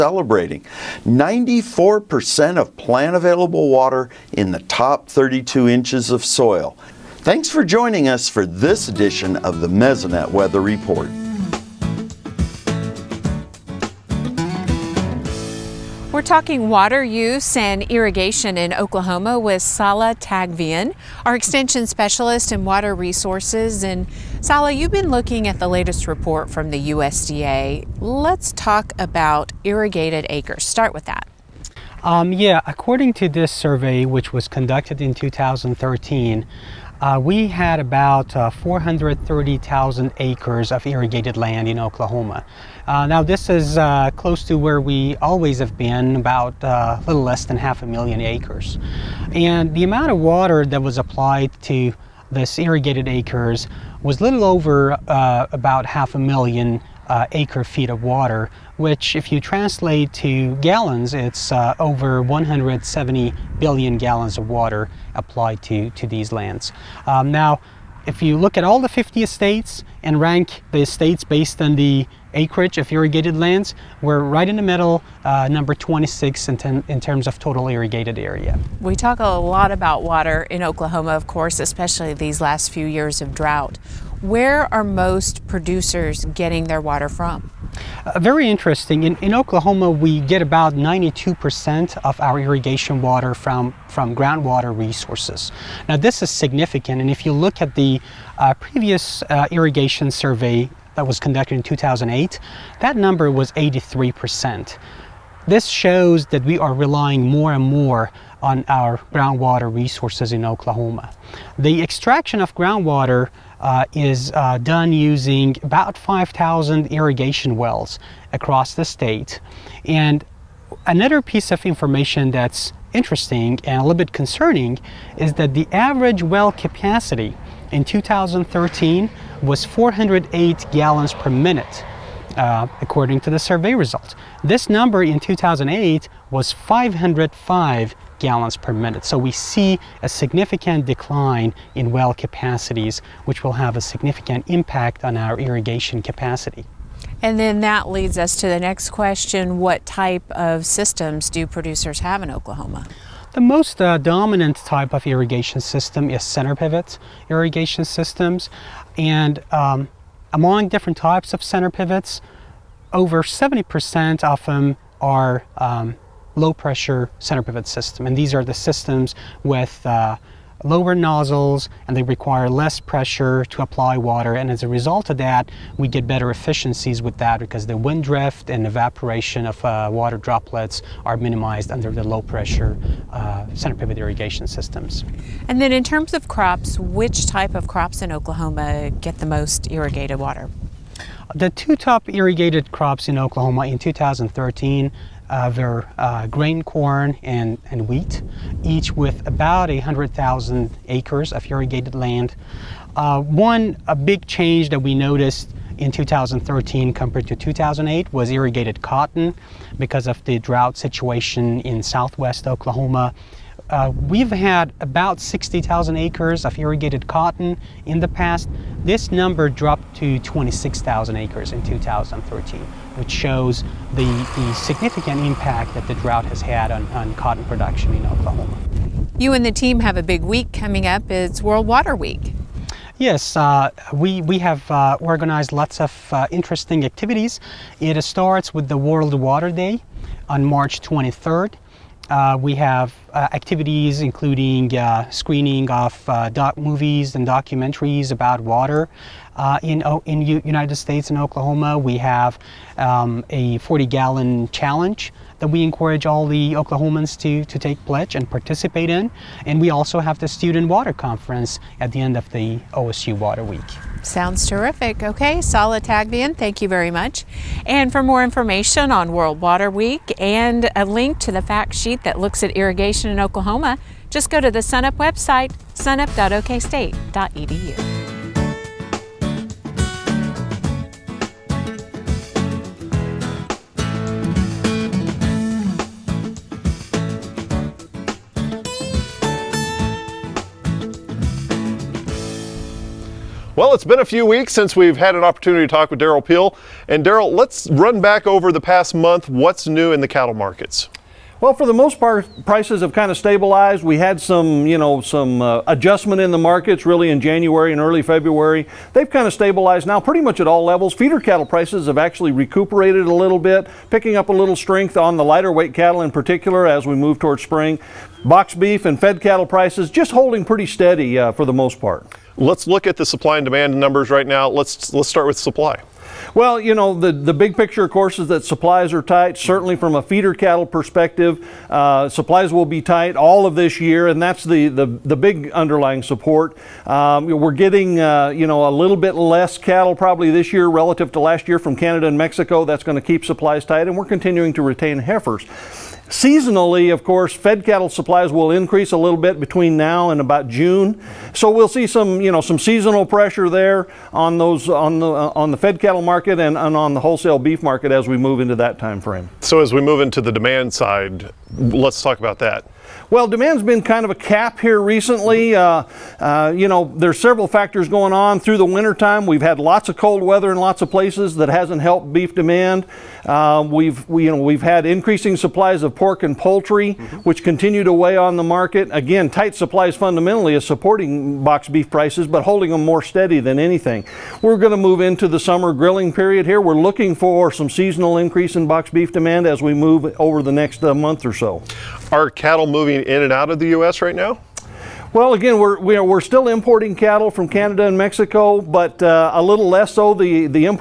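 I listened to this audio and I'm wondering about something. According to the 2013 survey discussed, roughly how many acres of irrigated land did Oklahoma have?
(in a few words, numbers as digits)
430,000 acres.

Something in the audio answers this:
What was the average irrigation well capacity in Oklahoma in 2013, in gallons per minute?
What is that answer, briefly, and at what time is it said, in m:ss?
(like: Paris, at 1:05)
408 gallons per minute, at 2:09.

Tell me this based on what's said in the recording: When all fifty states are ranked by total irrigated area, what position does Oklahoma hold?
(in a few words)
26.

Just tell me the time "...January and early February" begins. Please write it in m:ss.
5:07.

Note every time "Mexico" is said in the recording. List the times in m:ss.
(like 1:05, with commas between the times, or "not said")
5:42, 6:37.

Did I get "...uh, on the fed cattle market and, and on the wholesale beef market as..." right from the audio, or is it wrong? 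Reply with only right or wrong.
right.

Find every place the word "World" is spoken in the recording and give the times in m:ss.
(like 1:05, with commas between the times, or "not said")
3:51, 3:58, 4:29.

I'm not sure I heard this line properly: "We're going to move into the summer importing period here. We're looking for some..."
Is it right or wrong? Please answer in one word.
wrong.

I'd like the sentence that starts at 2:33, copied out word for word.
The most uh, dominant type of irrigation system is center pivot irrigation systems.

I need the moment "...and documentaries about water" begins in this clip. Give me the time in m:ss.
4:07.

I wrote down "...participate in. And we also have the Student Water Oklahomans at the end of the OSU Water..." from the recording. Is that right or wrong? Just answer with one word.
wrong.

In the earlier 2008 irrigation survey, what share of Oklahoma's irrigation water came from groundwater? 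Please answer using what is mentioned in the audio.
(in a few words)
83%.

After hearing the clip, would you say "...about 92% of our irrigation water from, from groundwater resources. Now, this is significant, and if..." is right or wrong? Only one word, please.
right.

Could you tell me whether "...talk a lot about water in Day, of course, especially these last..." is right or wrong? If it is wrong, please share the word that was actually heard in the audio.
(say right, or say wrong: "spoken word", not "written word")
wrong: "Oklahoma", not "Day".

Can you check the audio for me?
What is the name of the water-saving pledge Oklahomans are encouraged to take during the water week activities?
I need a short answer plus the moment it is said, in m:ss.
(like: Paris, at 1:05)
40-gallon challenge, at 4:13.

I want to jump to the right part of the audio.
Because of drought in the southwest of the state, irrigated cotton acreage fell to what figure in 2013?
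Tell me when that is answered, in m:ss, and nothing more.
3:40.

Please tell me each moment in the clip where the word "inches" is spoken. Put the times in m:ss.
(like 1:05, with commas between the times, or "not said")
0:05.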